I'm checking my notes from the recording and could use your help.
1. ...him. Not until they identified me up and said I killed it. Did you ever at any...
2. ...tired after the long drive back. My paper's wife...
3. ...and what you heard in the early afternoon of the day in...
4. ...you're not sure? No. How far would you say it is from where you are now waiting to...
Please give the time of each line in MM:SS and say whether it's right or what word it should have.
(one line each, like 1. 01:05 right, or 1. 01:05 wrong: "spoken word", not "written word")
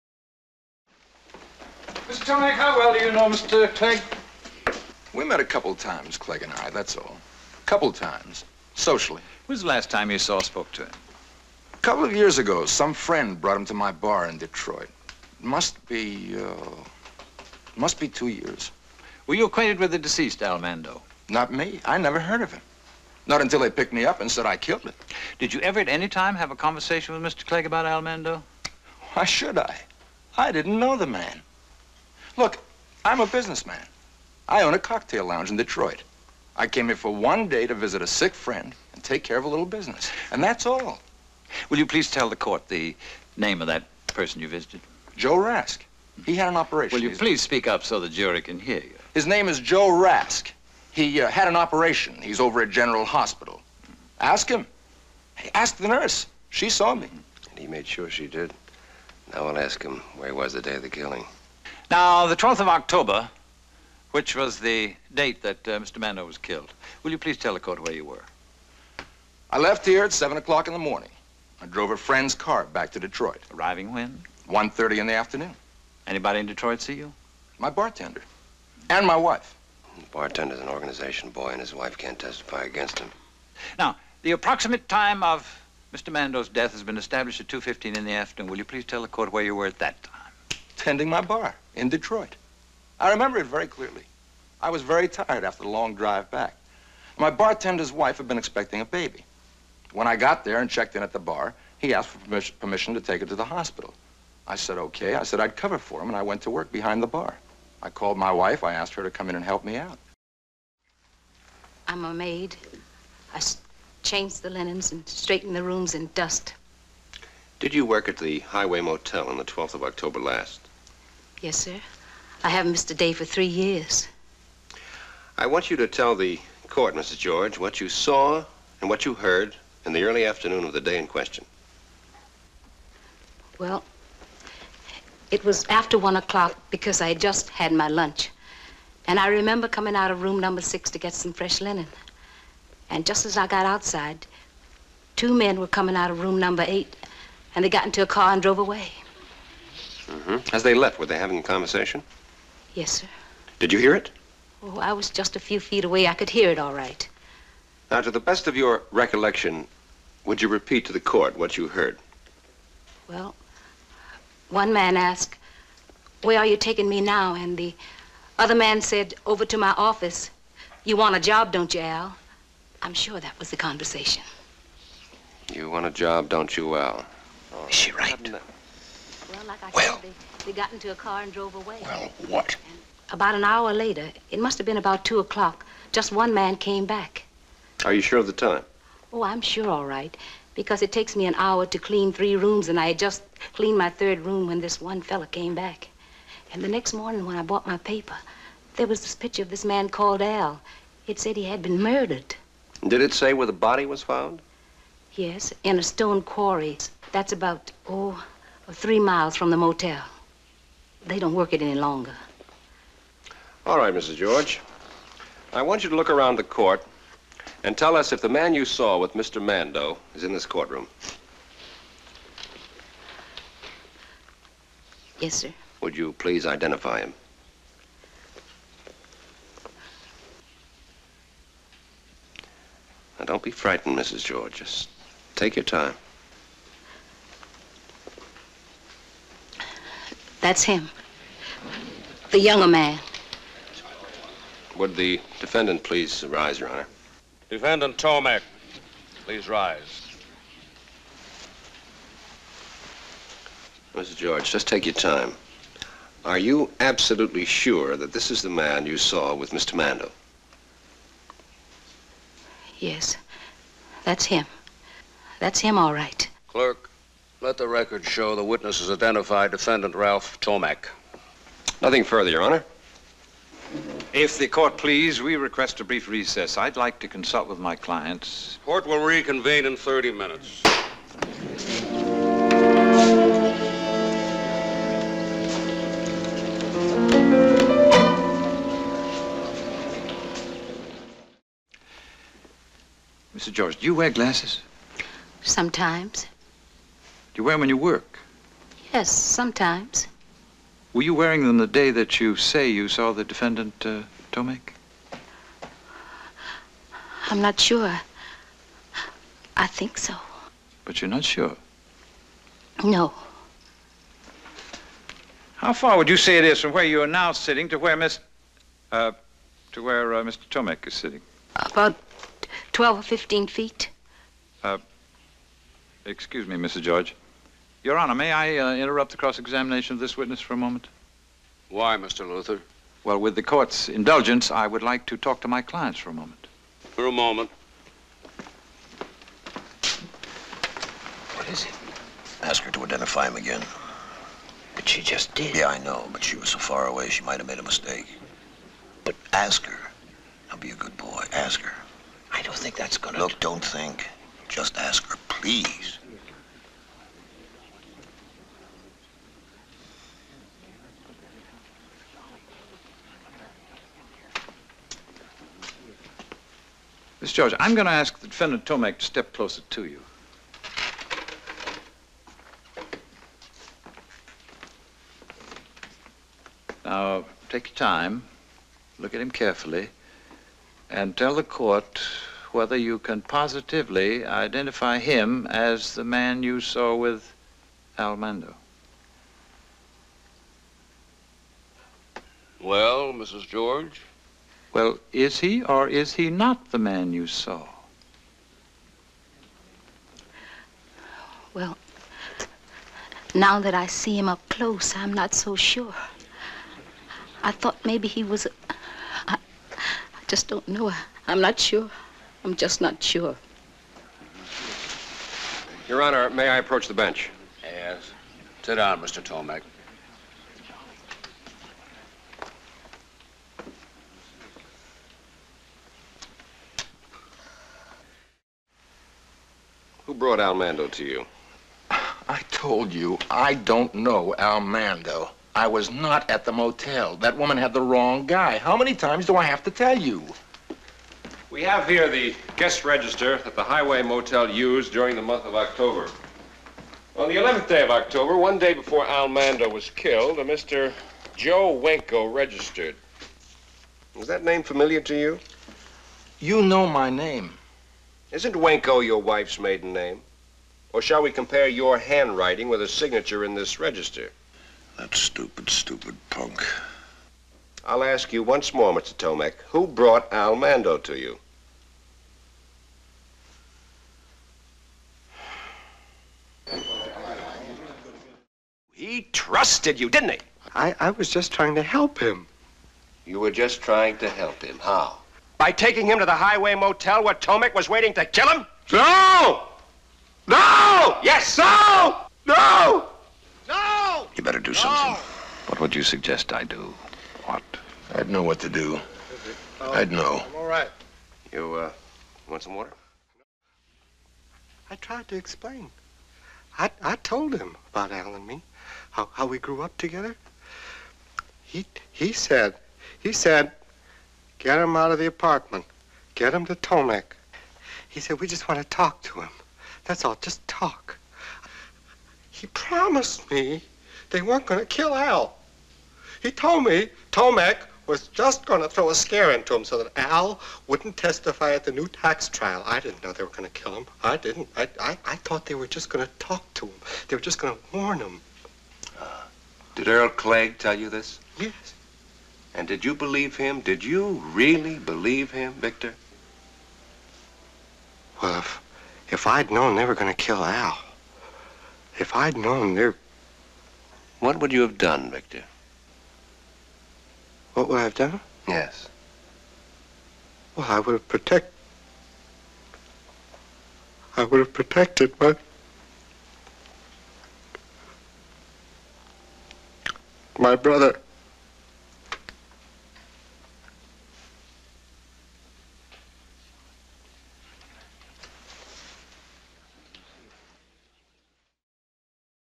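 1. 00:22 wrong: "picked", not "identified"
2. 01:35 wrong: "bartender", not "paper"
3. 02:08 right
4. 05:11 wrong: "sitting", not "waiting".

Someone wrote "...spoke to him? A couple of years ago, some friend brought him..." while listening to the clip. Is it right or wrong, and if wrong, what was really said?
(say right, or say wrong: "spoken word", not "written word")
right.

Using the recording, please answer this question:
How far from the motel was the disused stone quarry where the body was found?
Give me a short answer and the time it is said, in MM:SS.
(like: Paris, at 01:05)
3 miles, at 03:28.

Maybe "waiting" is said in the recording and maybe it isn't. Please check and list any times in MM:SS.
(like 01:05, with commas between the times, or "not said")
08:07.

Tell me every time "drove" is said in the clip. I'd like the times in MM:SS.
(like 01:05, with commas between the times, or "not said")
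01:11, 02:28, 03:01.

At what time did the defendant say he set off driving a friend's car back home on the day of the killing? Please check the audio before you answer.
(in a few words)
7 o'clock in the morning.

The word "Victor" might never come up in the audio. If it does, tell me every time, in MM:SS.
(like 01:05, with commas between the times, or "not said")
09:05, 09:15.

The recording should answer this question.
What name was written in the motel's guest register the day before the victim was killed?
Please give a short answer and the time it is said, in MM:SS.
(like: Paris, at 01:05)
Joe Wenko, at 07:31.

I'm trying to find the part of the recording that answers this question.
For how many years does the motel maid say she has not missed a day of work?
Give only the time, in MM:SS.
02:03.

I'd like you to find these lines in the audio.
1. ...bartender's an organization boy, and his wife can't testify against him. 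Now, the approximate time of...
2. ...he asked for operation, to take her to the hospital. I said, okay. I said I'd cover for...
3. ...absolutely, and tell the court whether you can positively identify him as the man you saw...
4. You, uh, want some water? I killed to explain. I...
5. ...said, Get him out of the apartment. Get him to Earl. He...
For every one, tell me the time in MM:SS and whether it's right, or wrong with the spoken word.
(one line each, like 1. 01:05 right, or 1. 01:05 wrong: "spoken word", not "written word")
1. 01:20 right
2. 01:41 wrong: "permission", not "operation"
3. 06:19 wrong: "carefully", not "absolutely"
4. 08:21 wrong: "tried", not "killed"
5. 08:33 wrong: "Tomek", not "Earl".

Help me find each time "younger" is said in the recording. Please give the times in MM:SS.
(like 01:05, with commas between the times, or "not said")
04:02.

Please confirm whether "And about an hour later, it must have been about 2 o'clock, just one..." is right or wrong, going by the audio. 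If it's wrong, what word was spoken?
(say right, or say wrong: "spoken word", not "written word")
right.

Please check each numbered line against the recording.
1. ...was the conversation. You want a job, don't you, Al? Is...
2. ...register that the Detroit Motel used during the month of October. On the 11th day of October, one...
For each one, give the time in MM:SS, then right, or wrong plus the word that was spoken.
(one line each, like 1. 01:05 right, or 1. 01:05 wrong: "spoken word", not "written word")
1. 02:53 right
2. 07:22 wrong: "Highway", not "Detroit".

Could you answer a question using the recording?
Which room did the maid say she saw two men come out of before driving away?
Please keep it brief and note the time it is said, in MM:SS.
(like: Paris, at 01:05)
Room number 8, at 02:26.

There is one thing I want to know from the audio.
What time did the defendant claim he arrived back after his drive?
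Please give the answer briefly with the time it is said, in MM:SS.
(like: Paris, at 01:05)
1:30 in the afternoon, at 01:14.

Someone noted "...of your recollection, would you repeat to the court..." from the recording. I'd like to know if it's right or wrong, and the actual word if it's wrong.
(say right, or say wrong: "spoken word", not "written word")
right.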